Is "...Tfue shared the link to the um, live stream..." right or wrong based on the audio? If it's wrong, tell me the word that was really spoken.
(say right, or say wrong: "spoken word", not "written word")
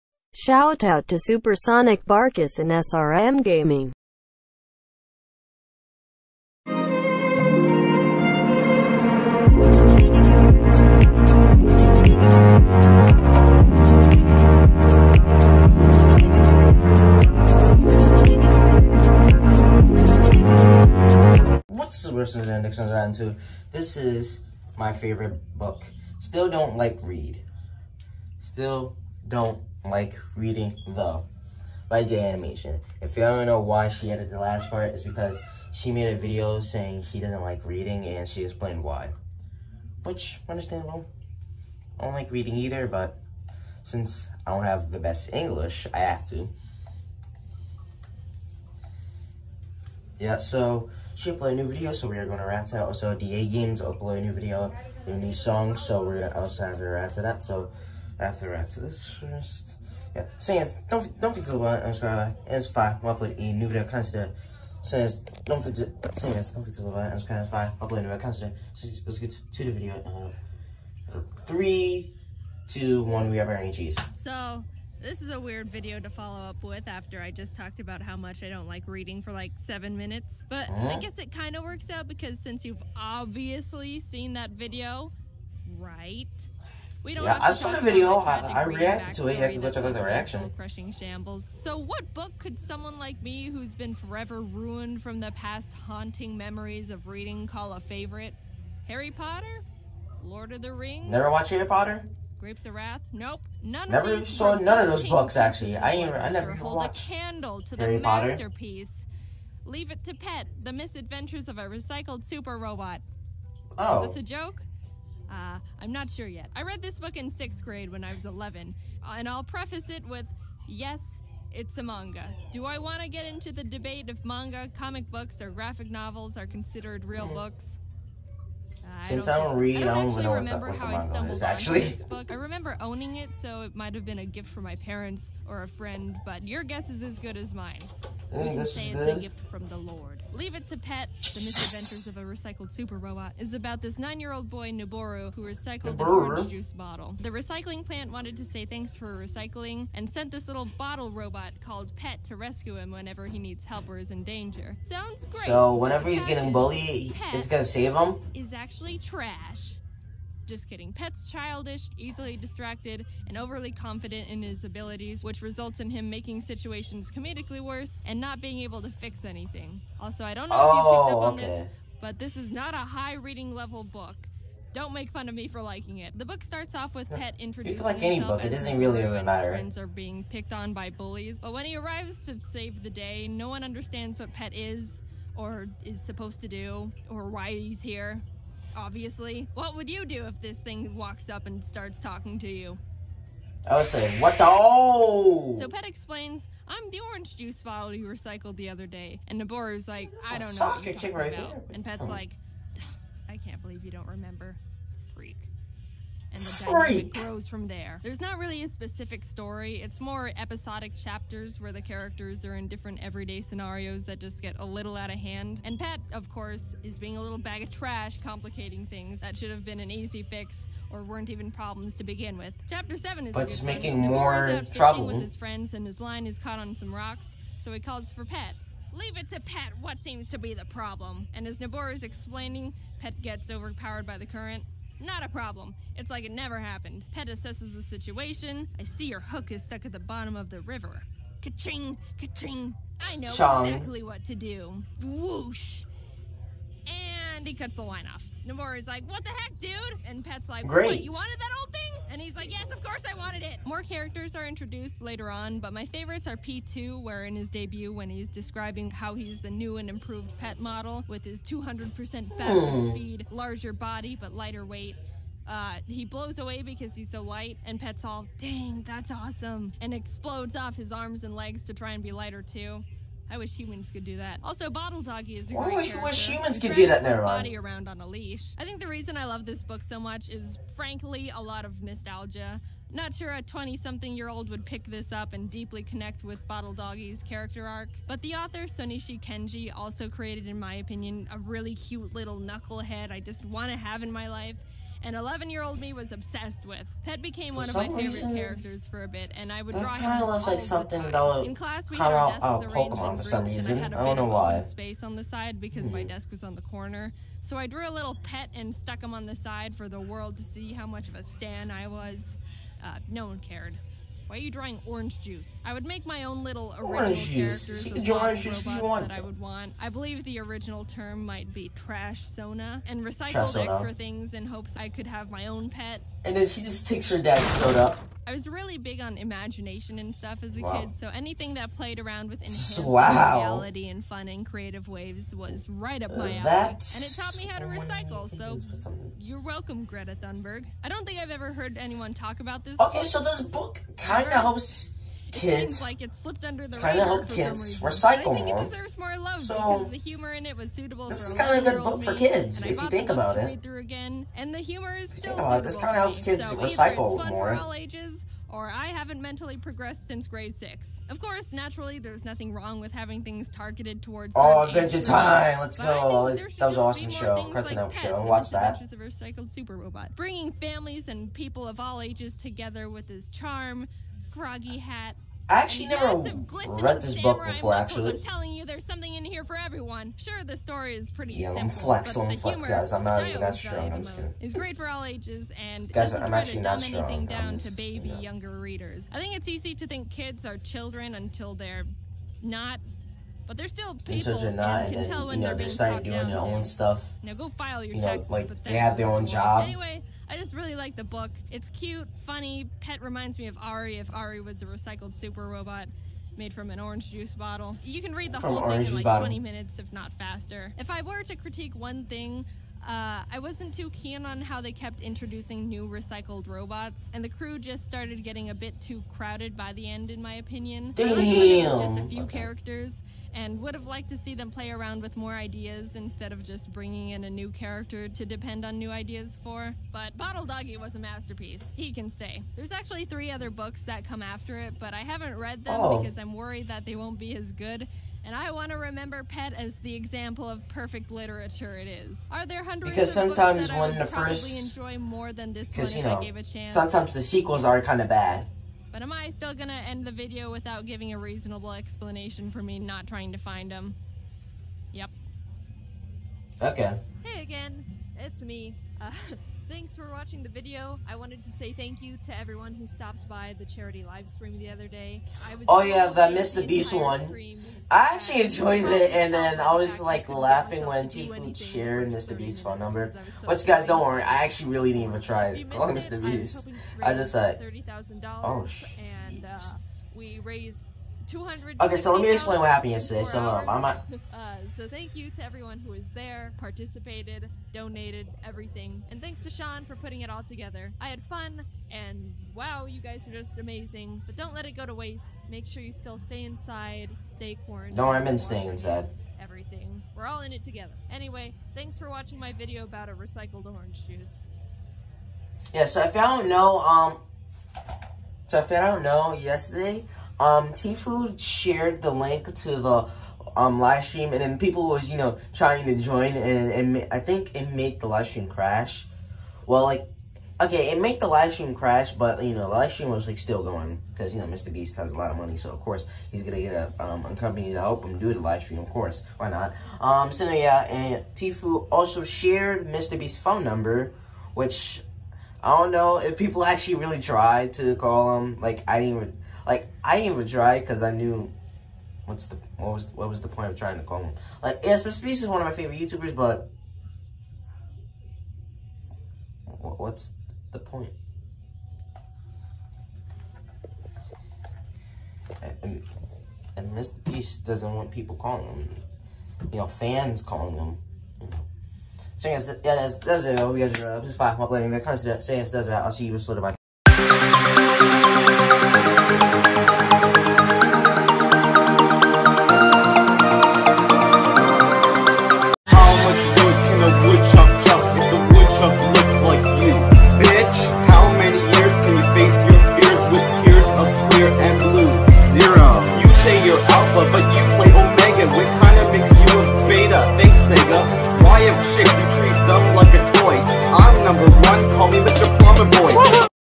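right.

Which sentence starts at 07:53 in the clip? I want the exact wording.
But you guys don't worry, I actually really didn't even try it.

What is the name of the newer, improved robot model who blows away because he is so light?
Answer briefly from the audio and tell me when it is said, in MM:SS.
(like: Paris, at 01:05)
P2, at 04:16.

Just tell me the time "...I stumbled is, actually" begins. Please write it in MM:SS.
02:10.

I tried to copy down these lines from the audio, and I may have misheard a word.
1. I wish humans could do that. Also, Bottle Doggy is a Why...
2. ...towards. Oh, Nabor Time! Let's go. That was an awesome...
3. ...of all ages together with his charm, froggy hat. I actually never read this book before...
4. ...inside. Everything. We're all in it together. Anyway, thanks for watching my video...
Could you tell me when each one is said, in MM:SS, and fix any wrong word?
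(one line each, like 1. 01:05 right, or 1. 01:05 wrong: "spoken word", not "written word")
1. 04:33 right
2. 06:04 wrong: "Adventure", not "Nabor"
3. 06:11 right
4. 08:18 right.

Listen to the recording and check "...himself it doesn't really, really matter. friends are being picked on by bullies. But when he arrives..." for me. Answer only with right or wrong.
right.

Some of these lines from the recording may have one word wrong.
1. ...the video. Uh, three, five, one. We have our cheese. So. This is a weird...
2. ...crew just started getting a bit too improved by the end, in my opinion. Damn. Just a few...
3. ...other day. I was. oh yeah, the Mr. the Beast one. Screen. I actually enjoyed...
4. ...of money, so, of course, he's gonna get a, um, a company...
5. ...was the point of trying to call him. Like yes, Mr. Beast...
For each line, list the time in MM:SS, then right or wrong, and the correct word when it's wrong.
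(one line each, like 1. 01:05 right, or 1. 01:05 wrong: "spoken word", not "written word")
1. 01:09 wrong: "two", not "five"
2. 06:57 wrong: "crowded", not "improved"
3. 07:44 right
4. 08:45 right
5. 09:03 right.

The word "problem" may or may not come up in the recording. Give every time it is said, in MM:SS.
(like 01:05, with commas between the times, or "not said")
03:41, 03:50, 03:55.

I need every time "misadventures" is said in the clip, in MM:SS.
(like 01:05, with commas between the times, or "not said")
01:50, 02:21.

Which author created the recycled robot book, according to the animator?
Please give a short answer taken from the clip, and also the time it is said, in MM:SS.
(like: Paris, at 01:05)
Sonishi Kenji, at 04:48.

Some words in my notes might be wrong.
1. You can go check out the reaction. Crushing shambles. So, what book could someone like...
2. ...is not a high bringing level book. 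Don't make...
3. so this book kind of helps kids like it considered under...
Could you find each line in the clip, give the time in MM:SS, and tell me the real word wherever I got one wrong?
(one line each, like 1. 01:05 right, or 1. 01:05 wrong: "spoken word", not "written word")
1. 01:29 right
2. 02:52 wrong: "reading", not "bringing"
3. 05:43 wrong: "slipped", not "considered".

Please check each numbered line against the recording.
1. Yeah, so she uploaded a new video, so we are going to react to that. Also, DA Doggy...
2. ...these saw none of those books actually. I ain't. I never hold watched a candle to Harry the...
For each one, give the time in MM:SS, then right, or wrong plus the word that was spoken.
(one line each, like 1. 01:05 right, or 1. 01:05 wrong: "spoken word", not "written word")
1. 00:50 wrong: "Games", not "Doggy"
2. 01:44 right.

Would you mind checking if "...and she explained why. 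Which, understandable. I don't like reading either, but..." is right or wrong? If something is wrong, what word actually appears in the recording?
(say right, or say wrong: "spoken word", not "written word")
right.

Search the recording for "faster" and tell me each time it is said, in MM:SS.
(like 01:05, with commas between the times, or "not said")
04:22, 06:50.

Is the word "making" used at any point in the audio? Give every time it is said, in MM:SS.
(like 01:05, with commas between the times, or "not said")
02:46, 03:43.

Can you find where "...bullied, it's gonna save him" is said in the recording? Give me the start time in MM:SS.
02:36.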